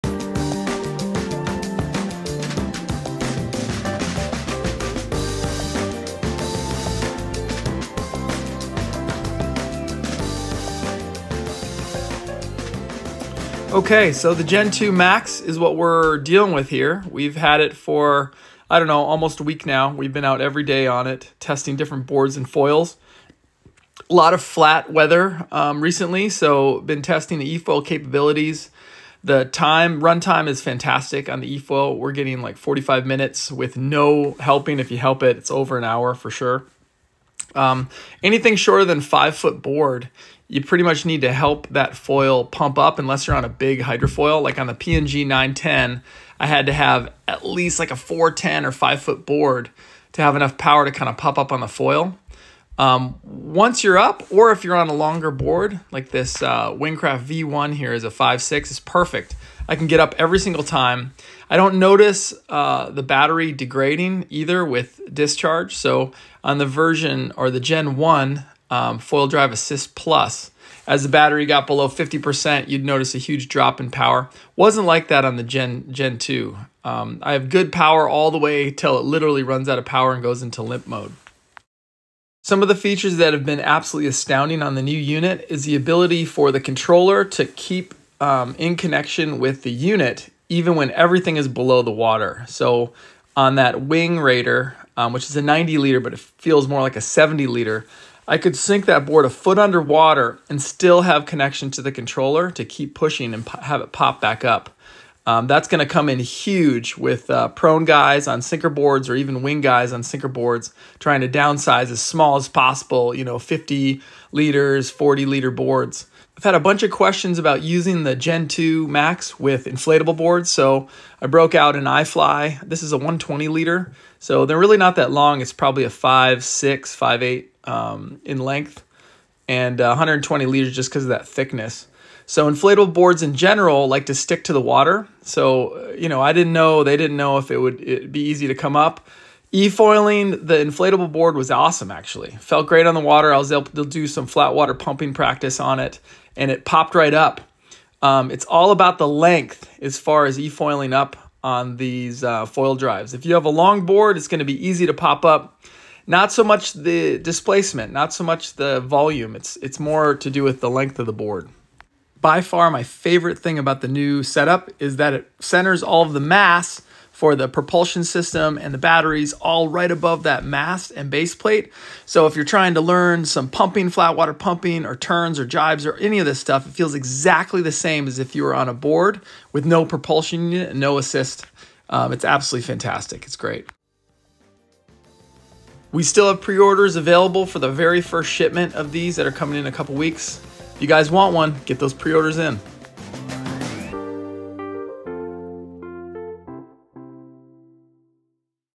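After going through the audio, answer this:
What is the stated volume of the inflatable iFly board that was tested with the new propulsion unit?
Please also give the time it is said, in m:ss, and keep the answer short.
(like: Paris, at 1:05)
120 liters, at 2:02.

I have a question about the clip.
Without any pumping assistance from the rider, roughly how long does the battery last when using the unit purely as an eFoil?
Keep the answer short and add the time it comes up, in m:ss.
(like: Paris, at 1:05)
45 minutes, at 0:32.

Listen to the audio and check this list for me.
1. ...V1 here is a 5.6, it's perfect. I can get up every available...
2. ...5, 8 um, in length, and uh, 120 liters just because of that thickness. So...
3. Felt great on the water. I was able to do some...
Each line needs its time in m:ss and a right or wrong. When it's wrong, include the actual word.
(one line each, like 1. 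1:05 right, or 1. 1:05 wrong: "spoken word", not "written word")
1. 0:57 wrong: "single", not "available"
2. 2:06 right
3. 2:22 right.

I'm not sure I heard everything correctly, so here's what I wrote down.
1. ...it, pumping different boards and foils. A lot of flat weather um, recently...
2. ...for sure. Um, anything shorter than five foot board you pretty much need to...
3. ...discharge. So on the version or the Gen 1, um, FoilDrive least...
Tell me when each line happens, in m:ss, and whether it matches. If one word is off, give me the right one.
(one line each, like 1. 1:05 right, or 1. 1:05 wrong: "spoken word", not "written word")
1. 0:21 wrong: "testing", not "pumping"
2. 0:36 right
3. 1:05 wrong: "assist", not "least".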